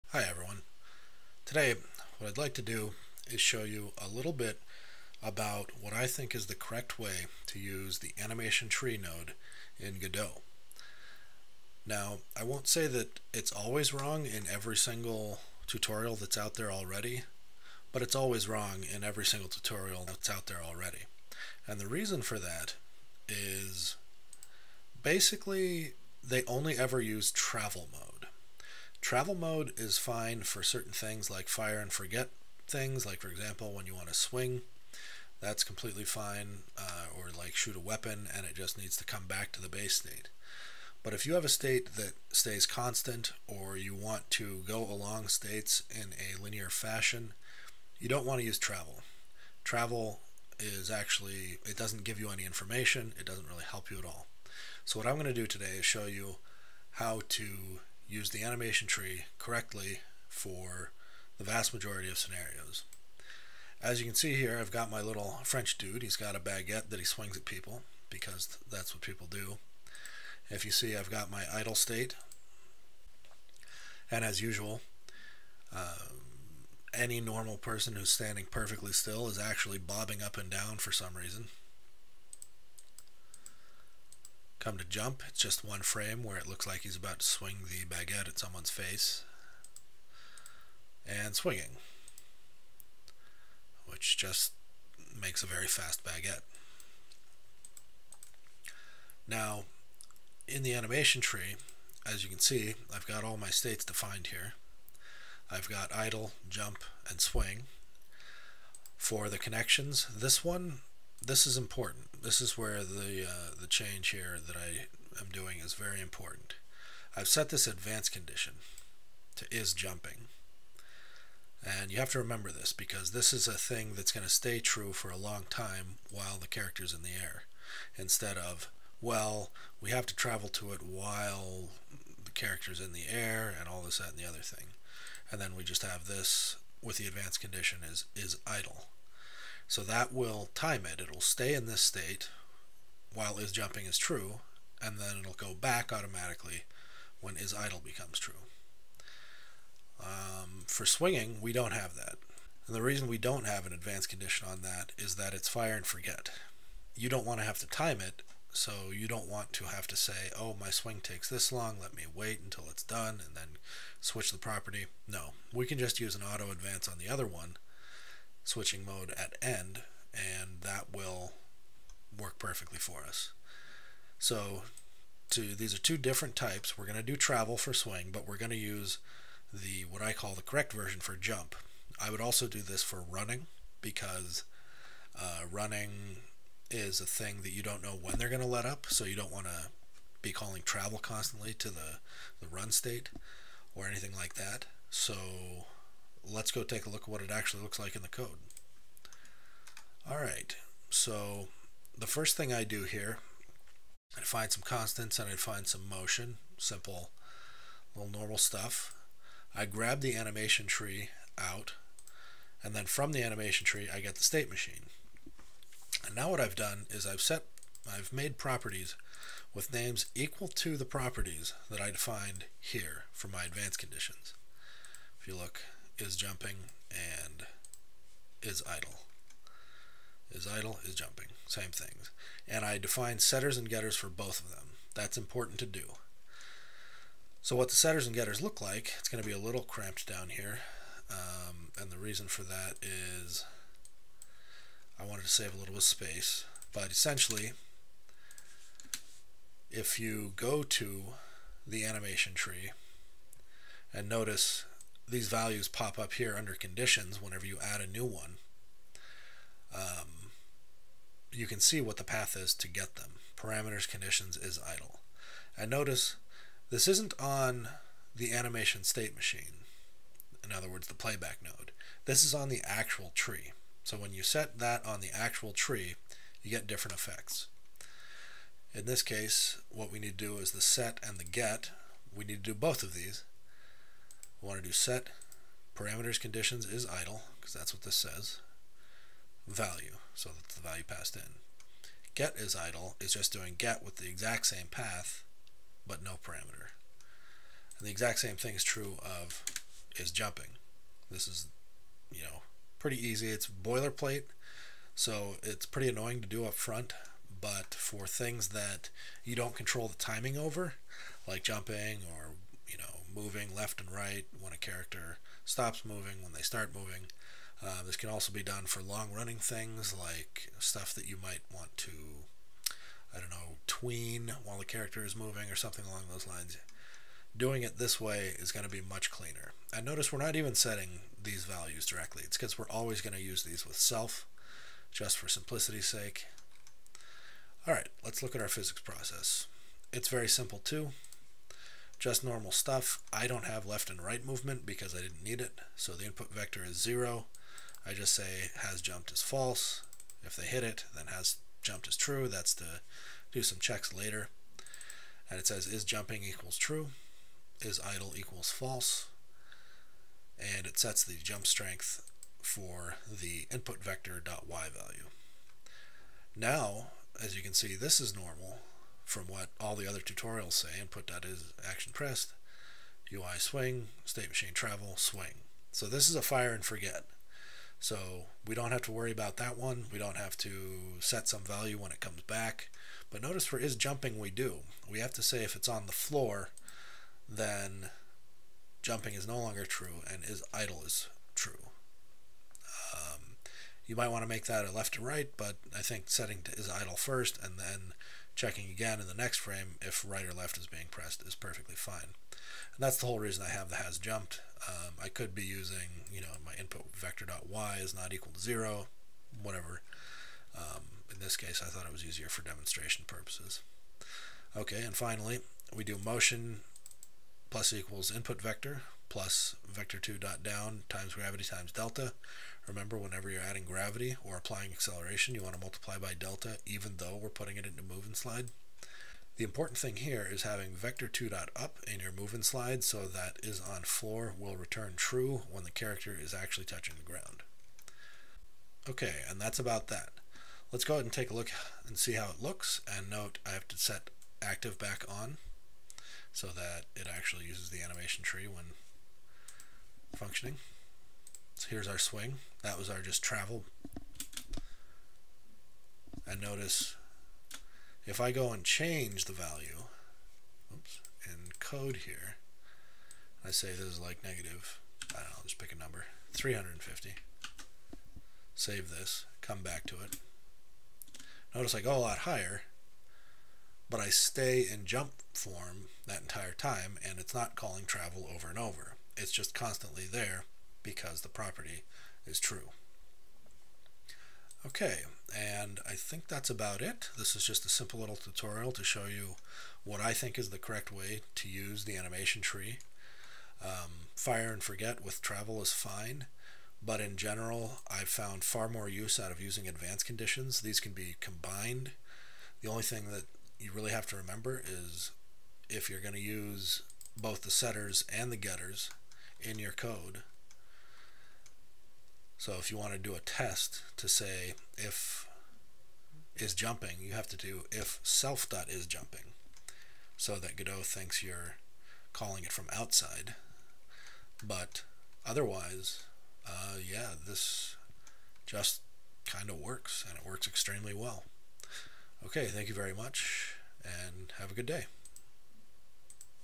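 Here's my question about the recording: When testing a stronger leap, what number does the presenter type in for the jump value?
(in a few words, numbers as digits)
-350.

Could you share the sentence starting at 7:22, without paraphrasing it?
And note, I have to set active back on so that it actually uses the animation tree when functioning.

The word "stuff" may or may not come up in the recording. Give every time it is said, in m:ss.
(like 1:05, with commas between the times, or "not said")
3:28, 5:20, 5:42.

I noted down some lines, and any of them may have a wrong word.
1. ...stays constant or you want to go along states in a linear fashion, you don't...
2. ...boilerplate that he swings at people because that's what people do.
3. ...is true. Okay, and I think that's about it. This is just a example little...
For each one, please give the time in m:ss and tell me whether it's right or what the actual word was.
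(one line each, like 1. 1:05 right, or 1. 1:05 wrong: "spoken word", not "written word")
1. 0:42 right
2. 1:06 wrong: "baguette", not "boilerplate"
3. 8:02 wrong: "simple", not "example".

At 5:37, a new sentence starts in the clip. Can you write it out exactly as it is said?
All right, let's look at our physics process.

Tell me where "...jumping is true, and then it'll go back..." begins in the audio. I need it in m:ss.
2:23.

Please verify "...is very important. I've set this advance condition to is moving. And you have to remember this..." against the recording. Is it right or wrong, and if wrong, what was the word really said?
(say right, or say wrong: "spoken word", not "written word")
wrong: "jumping", not "moving".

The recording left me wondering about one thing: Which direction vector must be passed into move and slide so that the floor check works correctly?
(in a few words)
vector2 dot up.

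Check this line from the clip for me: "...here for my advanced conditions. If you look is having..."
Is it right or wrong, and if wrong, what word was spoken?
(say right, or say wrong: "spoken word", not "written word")
wrong: "jumping", not "having".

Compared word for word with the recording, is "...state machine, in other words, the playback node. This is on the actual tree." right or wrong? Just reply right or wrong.
right.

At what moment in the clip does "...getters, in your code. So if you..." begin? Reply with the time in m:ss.
8:28.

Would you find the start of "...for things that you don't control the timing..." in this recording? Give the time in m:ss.
5:07.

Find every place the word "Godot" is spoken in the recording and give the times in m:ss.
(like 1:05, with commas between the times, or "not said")
0:09, 8:40.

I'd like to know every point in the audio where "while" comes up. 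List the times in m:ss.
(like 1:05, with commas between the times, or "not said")
2:06, 2:10, 2:23, 5:24.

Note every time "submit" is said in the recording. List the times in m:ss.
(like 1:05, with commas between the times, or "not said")
not said.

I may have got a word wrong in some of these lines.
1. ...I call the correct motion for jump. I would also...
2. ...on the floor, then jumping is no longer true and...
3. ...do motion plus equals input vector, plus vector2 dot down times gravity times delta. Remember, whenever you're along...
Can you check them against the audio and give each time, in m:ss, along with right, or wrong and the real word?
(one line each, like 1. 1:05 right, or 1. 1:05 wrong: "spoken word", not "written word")
1. 3:00 wrong: "version", not "motion"
2. 6:25 right
3. 6:55 wrong: "adding", not "along".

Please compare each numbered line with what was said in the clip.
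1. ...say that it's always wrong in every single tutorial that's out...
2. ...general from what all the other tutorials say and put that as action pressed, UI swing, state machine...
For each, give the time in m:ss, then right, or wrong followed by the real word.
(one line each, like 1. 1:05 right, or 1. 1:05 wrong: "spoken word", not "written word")
1. 0:12 right
2. 6:08 wrong: "normal", not "general".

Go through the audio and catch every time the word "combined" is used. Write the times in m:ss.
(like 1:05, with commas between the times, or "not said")
8:21.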